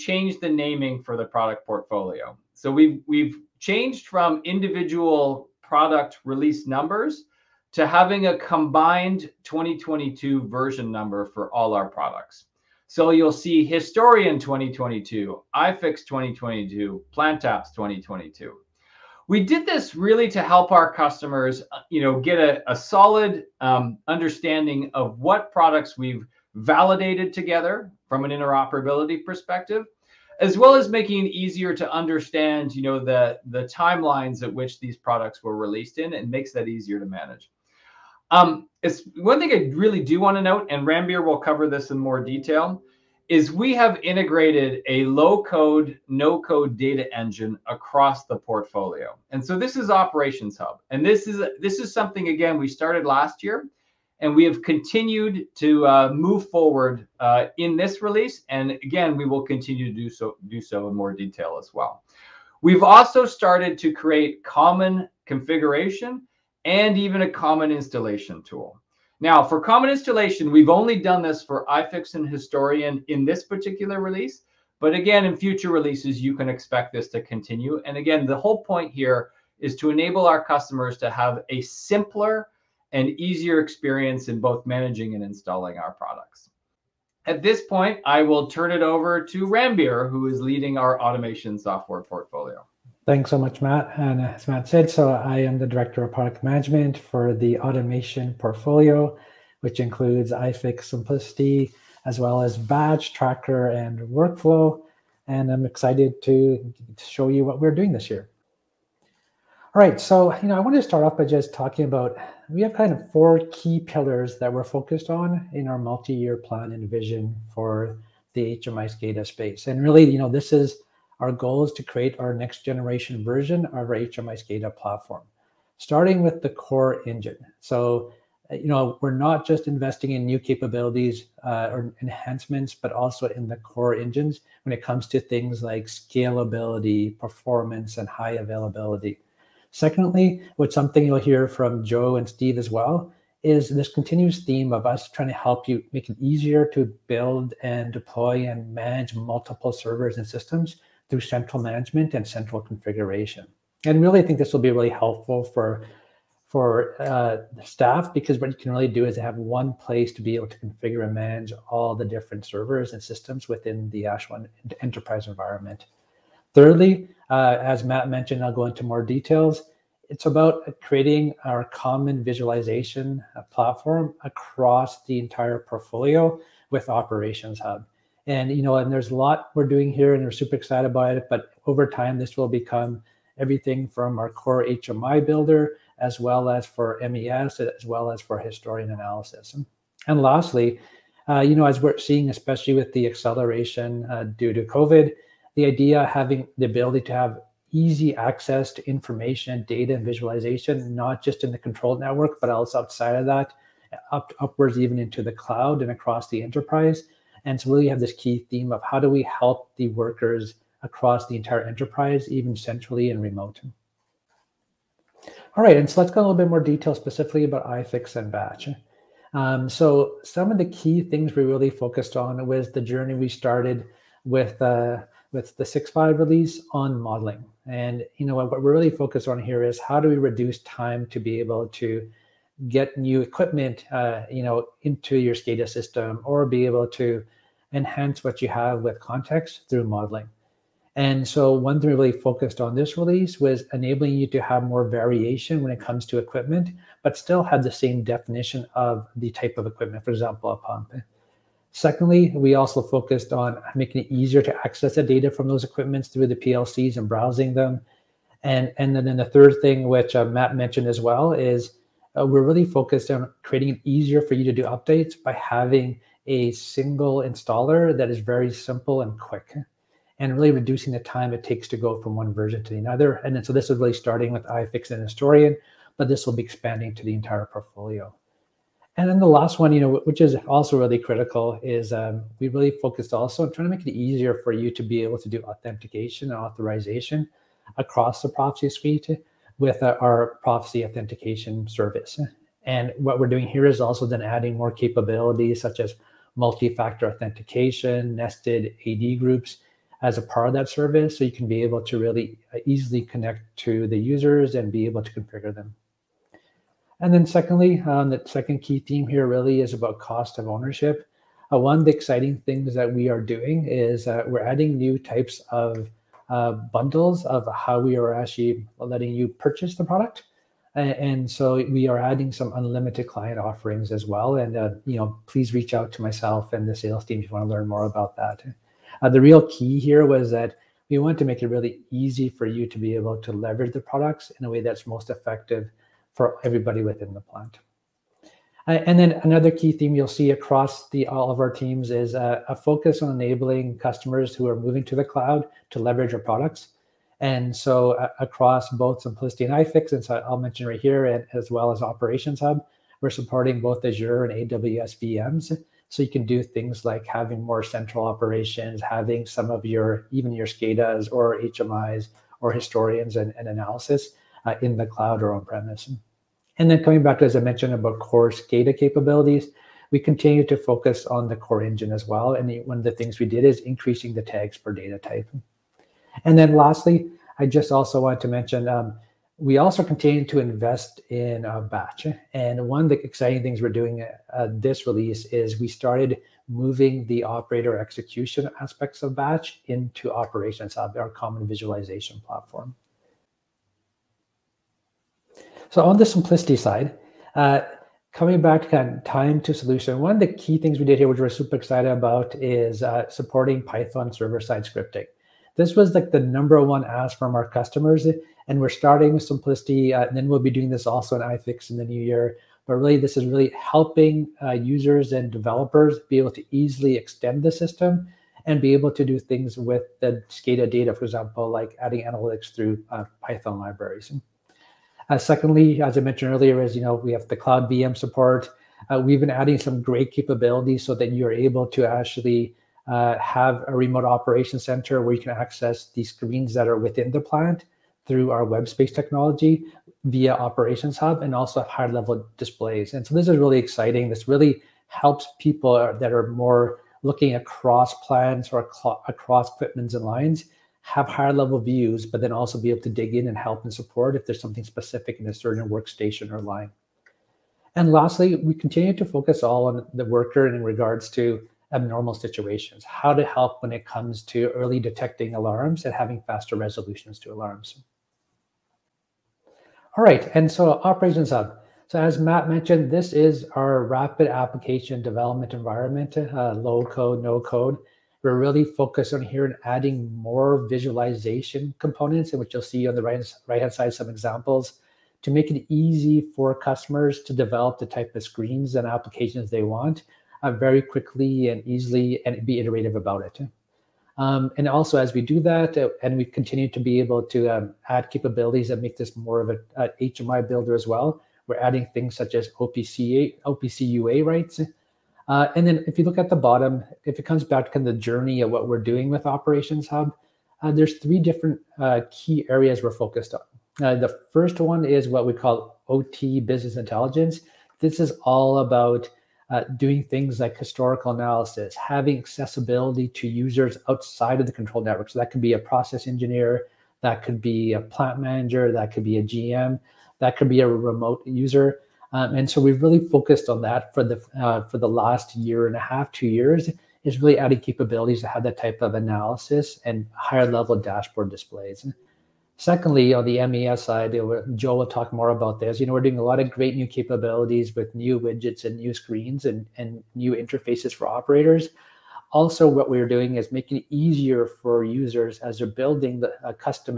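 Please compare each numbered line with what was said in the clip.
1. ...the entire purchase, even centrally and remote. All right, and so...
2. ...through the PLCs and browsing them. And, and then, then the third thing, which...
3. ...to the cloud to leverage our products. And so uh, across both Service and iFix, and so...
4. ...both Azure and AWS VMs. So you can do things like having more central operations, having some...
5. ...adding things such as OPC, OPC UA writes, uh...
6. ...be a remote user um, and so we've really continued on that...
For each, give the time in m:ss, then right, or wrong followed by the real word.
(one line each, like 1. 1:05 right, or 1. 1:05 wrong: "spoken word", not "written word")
1. 3:31 wrong: "enterprise", not "purchase"
2. 4:16 right
3. 5:44 wrong: "CIMPLICITY", not "Service"
4. 5:53 right
5. 8:21 right
6. 8:50 wrong: "focused", not "continued".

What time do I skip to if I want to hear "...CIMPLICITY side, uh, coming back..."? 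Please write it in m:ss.
6:36.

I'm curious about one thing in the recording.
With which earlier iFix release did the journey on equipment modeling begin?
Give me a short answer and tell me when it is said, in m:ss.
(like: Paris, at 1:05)
6.5, at 3:45.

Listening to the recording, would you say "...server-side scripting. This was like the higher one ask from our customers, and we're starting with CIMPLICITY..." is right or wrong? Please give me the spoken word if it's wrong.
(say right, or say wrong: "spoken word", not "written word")
wrong: "number", not "higher".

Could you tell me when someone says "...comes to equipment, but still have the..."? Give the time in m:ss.
4:05.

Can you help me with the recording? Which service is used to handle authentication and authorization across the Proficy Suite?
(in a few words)
Proficy Authentication Service.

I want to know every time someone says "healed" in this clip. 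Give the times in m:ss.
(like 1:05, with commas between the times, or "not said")
not said.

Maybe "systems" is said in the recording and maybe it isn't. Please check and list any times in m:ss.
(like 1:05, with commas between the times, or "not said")
2:30, 2:43, 3:55, 6:57.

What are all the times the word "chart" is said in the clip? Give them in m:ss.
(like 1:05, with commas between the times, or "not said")
not said.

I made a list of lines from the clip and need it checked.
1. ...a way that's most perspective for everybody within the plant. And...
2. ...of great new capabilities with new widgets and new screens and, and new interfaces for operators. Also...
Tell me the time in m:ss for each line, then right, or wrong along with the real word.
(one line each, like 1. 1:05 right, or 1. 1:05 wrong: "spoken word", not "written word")
1. 5:34 wrong: "effective", not "perspective"
2. 9:06 right.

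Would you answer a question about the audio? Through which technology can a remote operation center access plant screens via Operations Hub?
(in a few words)
WebSpace.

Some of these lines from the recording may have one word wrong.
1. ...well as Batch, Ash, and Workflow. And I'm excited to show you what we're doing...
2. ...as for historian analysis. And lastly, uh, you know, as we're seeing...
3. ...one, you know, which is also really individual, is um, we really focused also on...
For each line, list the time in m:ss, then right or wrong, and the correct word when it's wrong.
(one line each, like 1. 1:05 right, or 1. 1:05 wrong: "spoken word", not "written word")
1. 1:42 wrong: "Tracker", not "Ash"
2. 3:08 right
3. 4:39 wrong: "critical", not "individual".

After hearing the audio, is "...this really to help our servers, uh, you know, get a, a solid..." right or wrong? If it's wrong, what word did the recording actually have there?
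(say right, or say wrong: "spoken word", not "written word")
wrong: "customers", not "servers".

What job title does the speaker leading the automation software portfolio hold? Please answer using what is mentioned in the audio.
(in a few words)
Director of Product Management.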